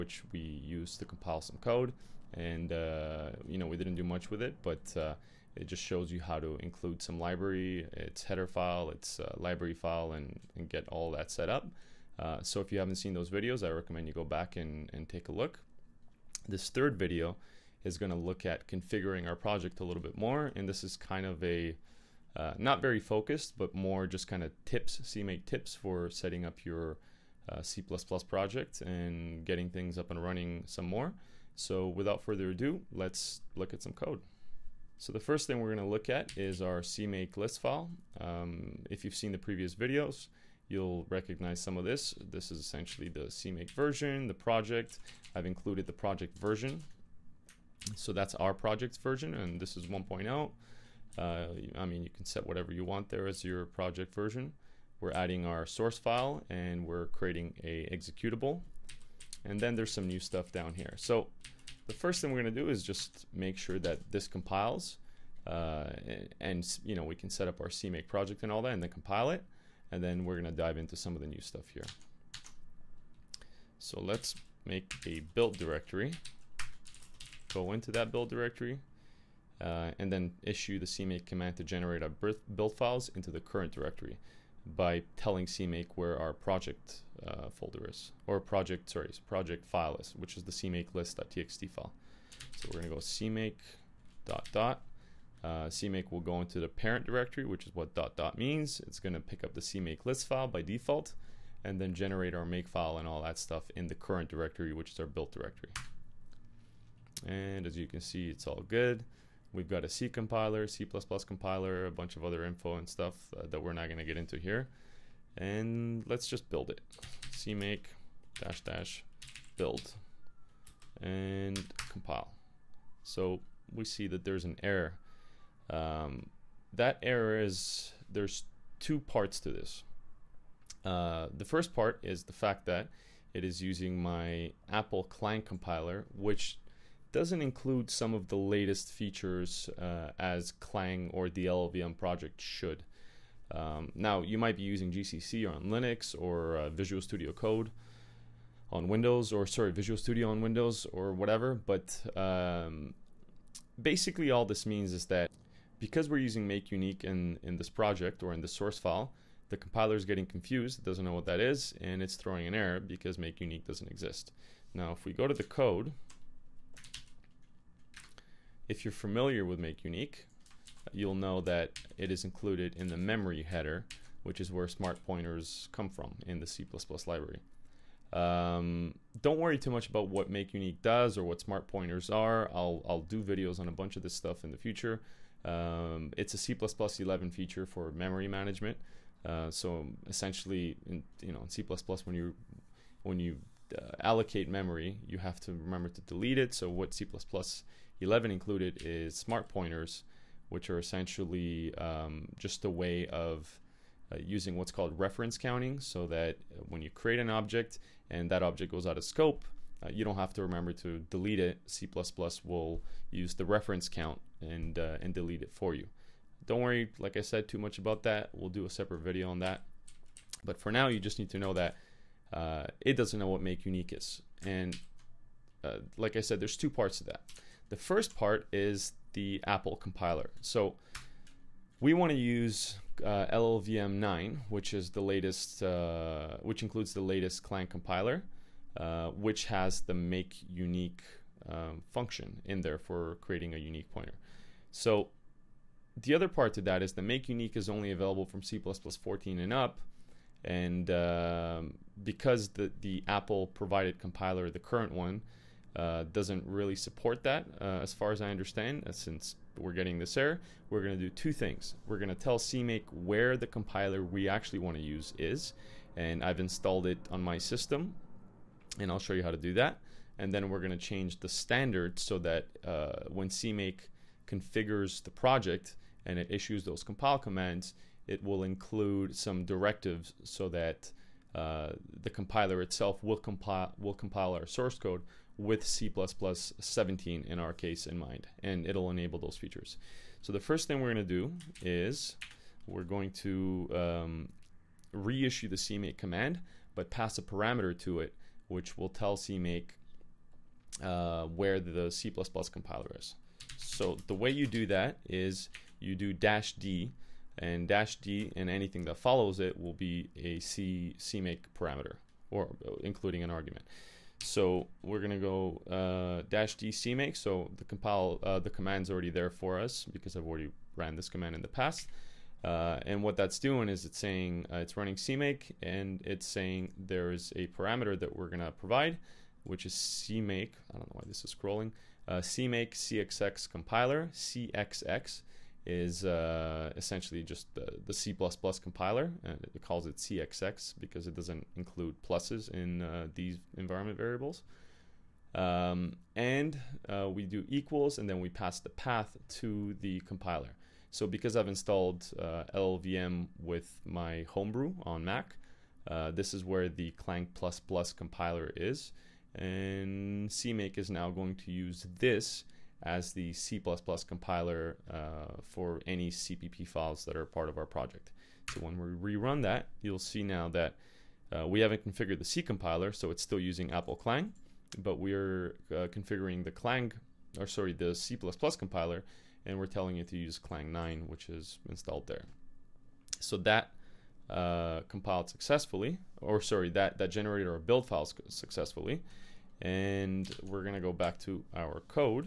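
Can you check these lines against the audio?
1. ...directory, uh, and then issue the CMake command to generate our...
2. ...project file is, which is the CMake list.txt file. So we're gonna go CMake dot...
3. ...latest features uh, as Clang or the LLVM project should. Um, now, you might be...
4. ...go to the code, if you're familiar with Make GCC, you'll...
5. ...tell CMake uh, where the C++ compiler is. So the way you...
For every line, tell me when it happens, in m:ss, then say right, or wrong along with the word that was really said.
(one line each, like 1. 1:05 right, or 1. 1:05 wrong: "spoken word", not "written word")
1. 1:18 right
2. 1:29 right
3. 2:18 right
4. 2:45 wrong: "Unique", not "GCC"
5. 4:58 right.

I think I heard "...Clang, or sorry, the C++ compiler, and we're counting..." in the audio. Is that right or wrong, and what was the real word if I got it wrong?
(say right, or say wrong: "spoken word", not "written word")
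wrong: "telling", not "counting".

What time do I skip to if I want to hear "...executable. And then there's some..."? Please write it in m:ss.
0:57.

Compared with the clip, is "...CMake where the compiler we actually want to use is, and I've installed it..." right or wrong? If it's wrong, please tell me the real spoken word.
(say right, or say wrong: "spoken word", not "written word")
right.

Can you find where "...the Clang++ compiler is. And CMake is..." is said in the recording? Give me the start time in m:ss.
5:56.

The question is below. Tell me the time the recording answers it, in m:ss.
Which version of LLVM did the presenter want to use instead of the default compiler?
3:53.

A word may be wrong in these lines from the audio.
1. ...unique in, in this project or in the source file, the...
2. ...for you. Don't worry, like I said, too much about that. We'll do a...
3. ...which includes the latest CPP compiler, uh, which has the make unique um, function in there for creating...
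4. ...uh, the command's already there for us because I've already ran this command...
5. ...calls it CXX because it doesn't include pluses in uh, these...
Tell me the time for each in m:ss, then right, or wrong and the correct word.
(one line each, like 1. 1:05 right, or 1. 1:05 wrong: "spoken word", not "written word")
1. 2:36 right
2. 3:35 right
3. 3:56 wrong: "Clang", not "CPP"
4. 5:18 right
5. 5:39 right.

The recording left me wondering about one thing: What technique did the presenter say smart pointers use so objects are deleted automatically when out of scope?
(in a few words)
reference counting.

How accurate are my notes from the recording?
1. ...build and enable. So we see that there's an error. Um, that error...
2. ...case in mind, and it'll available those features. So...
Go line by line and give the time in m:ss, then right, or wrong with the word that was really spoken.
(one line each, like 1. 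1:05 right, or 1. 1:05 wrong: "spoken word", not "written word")
1. 1:59 wrong: "compile", not "enable"
2. 4:47 wrong: "enable", not "available".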